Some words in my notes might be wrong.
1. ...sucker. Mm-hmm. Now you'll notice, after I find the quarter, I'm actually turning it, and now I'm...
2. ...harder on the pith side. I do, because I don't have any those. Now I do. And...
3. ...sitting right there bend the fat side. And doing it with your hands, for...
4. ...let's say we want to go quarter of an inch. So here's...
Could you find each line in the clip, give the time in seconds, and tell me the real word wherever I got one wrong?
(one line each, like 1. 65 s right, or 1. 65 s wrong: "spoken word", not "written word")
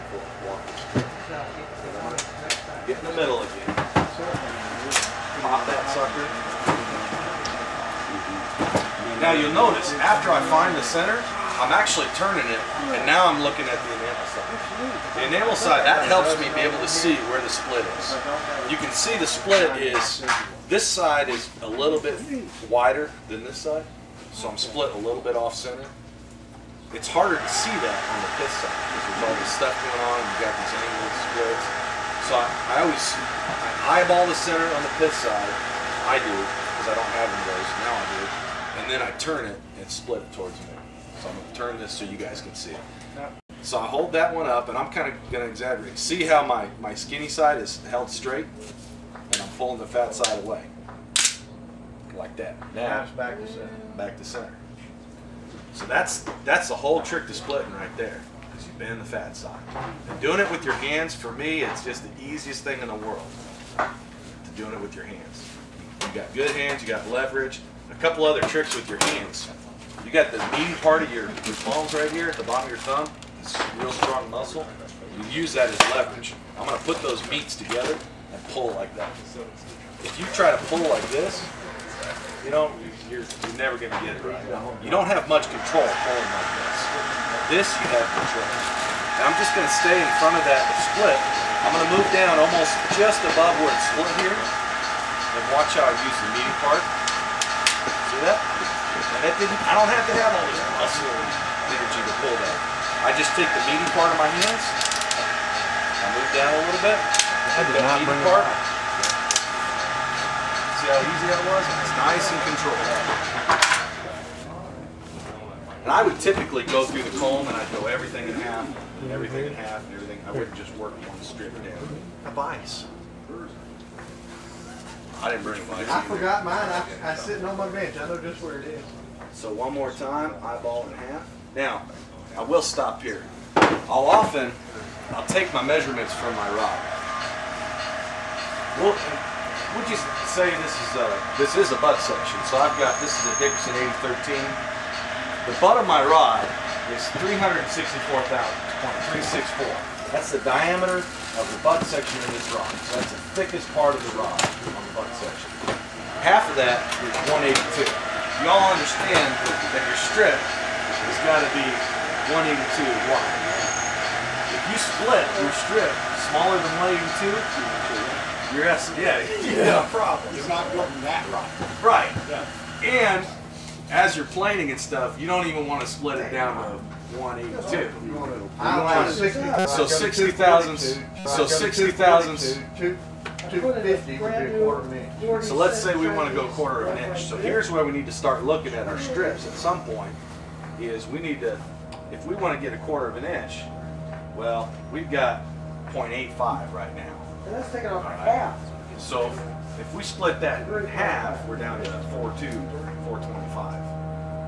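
1. 5 s wrong: "center", not "quarter"
2. 34 s wrong: "center", not "harder"
3. 57 s wrong: "splitting", not "sitting"
4. 185 s right.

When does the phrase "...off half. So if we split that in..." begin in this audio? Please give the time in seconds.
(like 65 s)
197 s.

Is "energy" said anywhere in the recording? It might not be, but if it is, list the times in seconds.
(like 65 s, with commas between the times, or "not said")
101 s.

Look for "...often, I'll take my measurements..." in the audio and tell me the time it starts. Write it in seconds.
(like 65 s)
134 s.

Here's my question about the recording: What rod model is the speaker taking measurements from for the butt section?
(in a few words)
Dickerson 8013.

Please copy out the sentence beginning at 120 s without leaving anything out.
I wouldn't just work one strip down.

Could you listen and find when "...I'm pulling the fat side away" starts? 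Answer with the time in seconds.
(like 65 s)
49 s.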